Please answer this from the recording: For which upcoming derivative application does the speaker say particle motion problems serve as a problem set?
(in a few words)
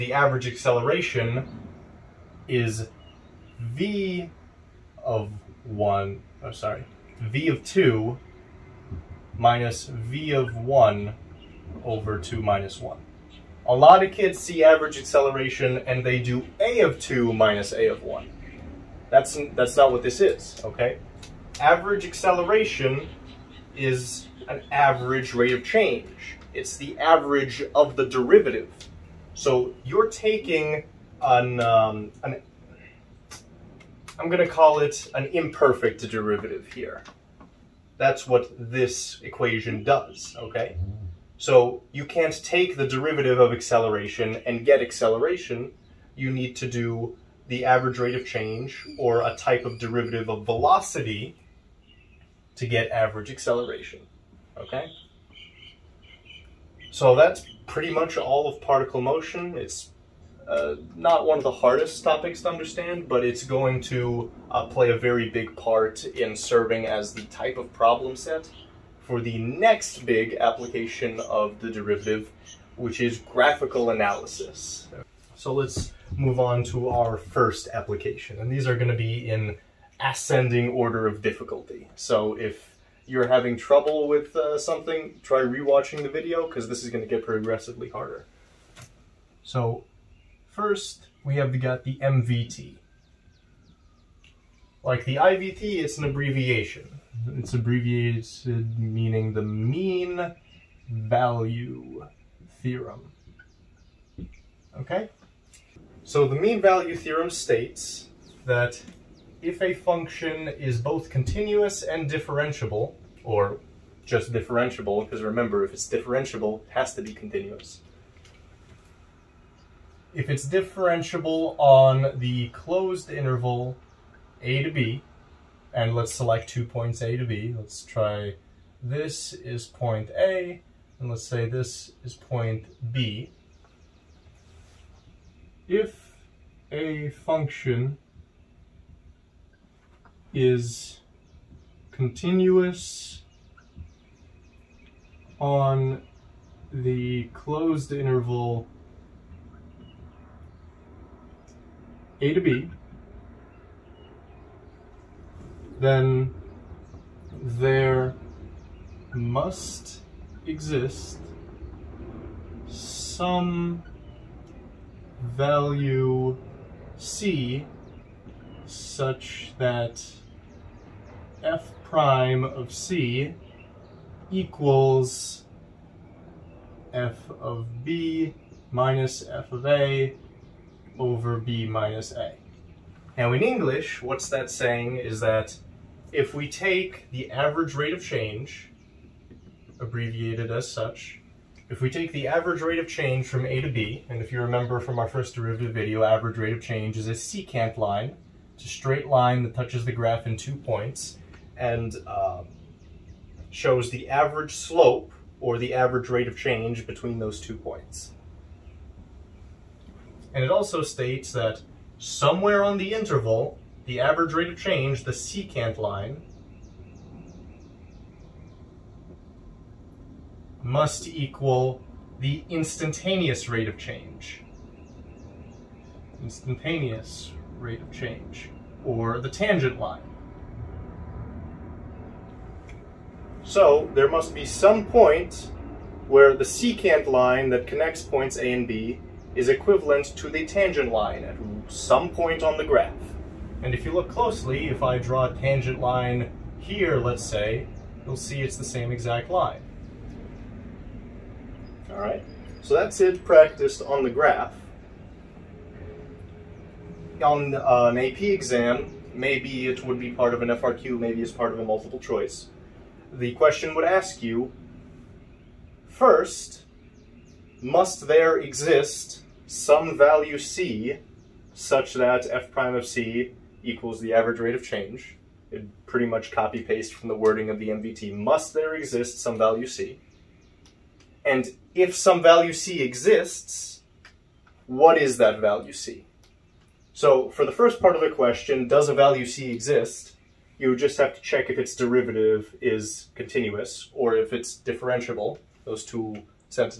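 graphical analysis.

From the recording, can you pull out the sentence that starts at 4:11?
All right, so that's it practiced on the graph.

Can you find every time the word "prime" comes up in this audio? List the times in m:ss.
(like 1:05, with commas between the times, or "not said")
2:51, 4:32.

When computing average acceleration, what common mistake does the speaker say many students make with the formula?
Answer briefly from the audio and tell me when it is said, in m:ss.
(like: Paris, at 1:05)
a of 2 minus a of 1, at 0:16.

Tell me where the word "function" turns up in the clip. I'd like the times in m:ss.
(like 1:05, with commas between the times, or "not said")
1:49, 2:17.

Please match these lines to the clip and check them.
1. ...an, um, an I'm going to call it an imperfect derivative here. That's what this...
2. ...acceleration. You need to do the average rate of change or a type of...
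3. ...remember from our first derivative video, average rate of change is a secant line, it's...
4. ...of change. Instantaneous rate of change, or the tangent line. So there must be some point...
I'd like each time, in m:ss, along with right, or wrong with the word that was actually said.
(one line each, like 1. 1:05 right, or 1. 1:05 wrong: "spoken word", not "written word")
1. 0:31 right
2. 0:44 right
3. 3:14 right
4. 3:43 right.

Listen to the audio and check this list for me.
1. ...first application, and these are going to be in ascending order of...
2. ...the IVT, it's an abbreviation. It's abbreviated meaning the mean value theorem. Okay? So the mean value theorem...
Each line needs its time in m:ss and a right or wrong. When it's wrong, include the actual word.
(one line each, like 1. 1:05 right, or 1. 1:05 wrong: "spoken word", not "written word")
1. 1:17 right
2. 1:35 right.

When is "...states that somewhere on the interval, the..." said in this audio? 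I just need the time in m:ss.
3:30.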